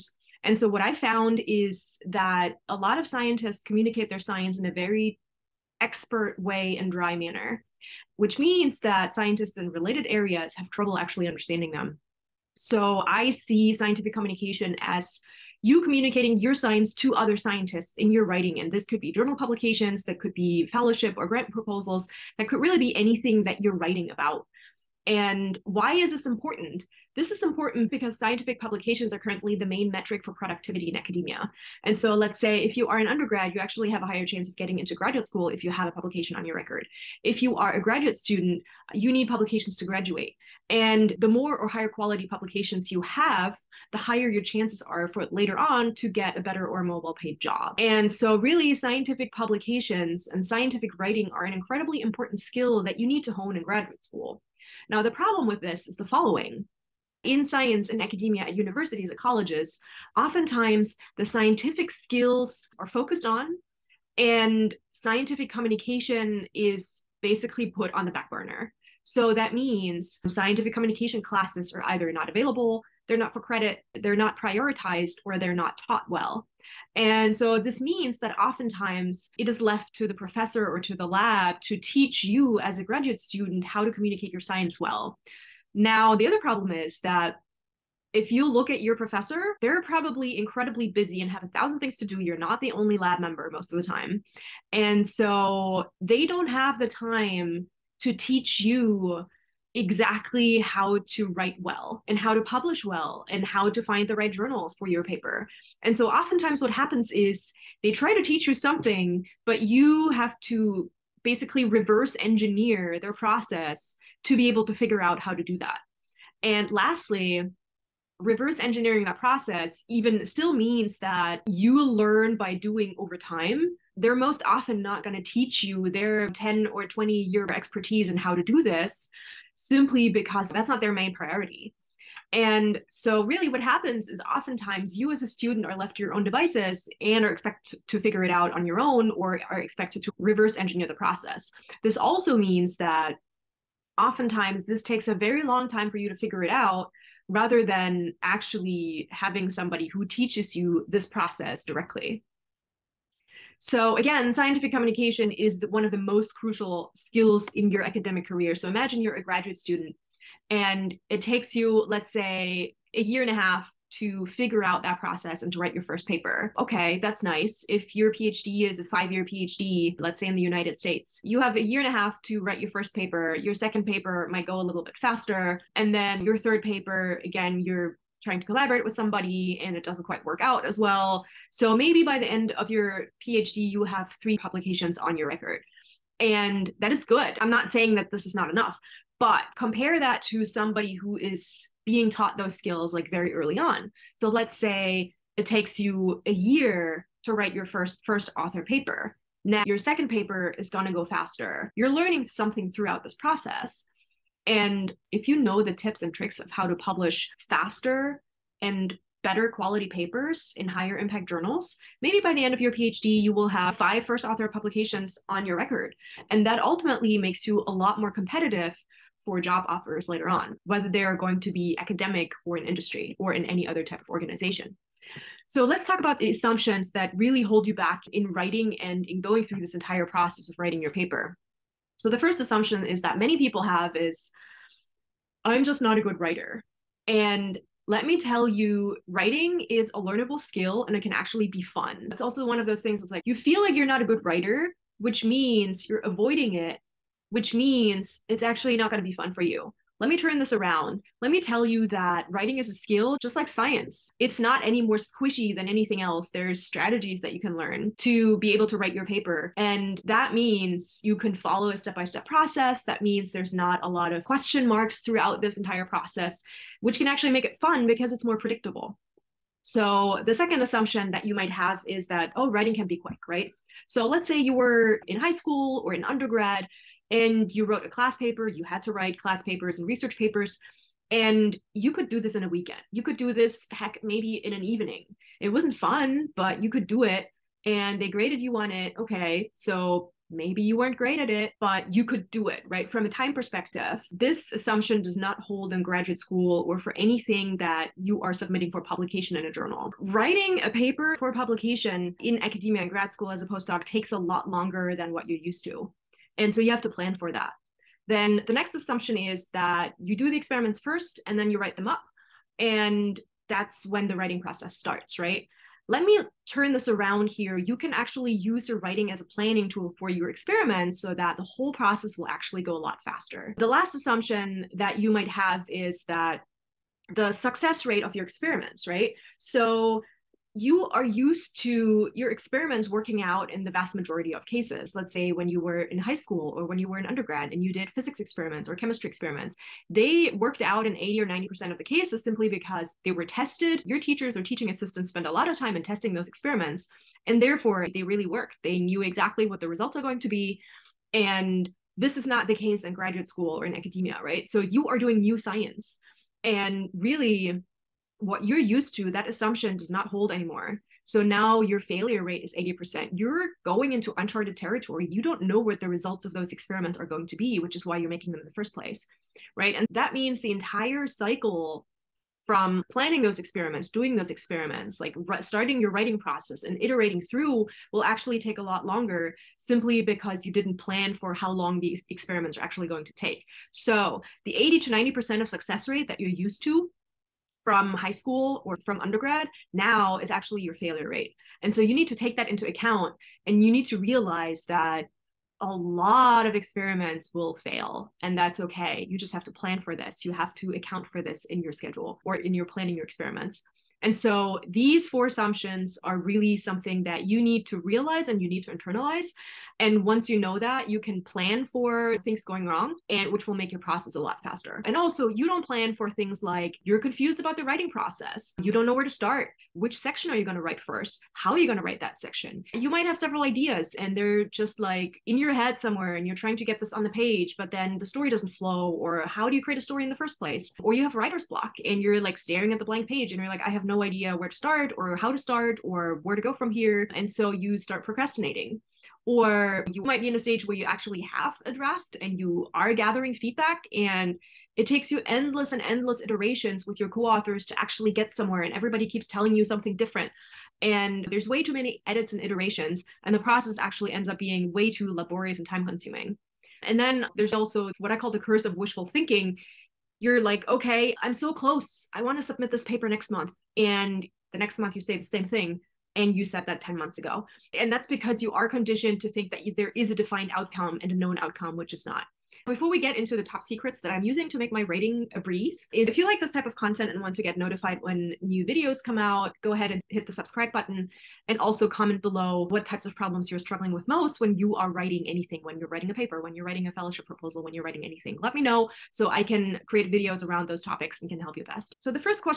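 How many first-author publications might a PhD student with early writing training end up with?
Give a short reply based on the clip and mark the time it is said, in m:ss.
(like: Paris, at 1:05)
5, at 3:33.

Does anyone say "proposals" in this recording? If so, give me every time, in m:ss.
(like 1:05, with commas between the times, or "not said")
0:21, 8:07.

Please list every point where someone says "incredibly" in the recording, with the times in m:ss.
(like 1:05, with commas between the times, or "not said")
0:51, 1:30.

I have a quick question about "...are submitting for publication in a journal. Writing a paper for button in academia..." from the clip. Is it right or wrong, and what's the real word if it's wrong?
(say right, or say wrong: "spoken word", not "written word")
wrong: "publication", not "button".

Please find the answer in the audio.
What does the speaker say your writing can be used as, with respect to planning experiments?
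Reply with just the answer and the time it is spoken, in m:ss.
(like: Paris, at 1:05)
a planning tool, at 5:19.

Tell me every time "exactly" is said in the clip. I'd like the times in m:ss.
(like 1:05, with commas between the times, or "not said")
1:39, 5:49.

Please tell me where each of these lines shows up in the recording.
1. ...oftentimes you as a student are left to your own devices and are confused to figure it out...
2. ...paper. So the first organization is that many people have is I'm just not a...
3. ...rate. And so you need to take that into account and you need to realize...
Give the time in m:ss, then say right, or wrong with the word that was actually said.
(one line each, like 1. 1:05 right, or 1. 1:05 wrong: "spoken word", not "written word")
1. 2:14 wrong: "expected", not "confused"
2. 3:50 wrong: "assumption", not "organization"
3. 6:31 right.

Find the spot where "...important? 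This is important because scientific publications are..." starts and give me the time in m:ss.
0:26.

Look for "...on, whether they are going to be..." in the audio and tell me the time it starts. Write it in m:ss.
3:40.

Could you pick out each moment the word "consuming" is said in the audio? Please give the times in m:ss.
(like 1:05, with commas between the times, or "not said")
7:35.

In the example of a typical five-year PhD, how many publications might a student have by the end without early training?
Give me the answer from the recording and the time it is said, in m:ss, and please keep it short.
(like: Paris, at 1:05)
3, at 3:04.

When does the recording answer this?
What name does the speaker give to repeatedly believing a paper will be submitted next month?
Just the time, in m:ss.
7:38.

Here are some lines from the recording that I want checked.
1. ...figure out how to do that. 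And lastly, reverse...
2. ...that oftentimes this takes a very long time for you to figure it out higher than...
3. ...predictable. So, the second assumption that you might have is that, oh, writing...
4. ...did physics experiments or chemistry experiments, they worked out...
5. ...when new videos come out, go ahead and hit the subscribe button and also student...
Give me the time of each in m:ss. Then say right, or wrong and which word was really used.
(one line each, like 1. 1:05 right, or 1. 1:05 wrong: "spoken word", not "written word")
1. 1:54 right
2. 2:22 wrong: "rather", not "higher"
3. 4:28 right
4. 5:37 right
5. 7:58 wrong: "comment", not "student".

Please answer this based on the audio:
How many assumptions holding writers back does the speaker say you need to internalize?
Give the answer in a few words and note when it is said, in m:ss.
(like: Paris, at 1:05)
4, at 6:45.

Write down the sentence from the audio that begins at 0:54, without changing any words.
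Now, the problem with this is the following.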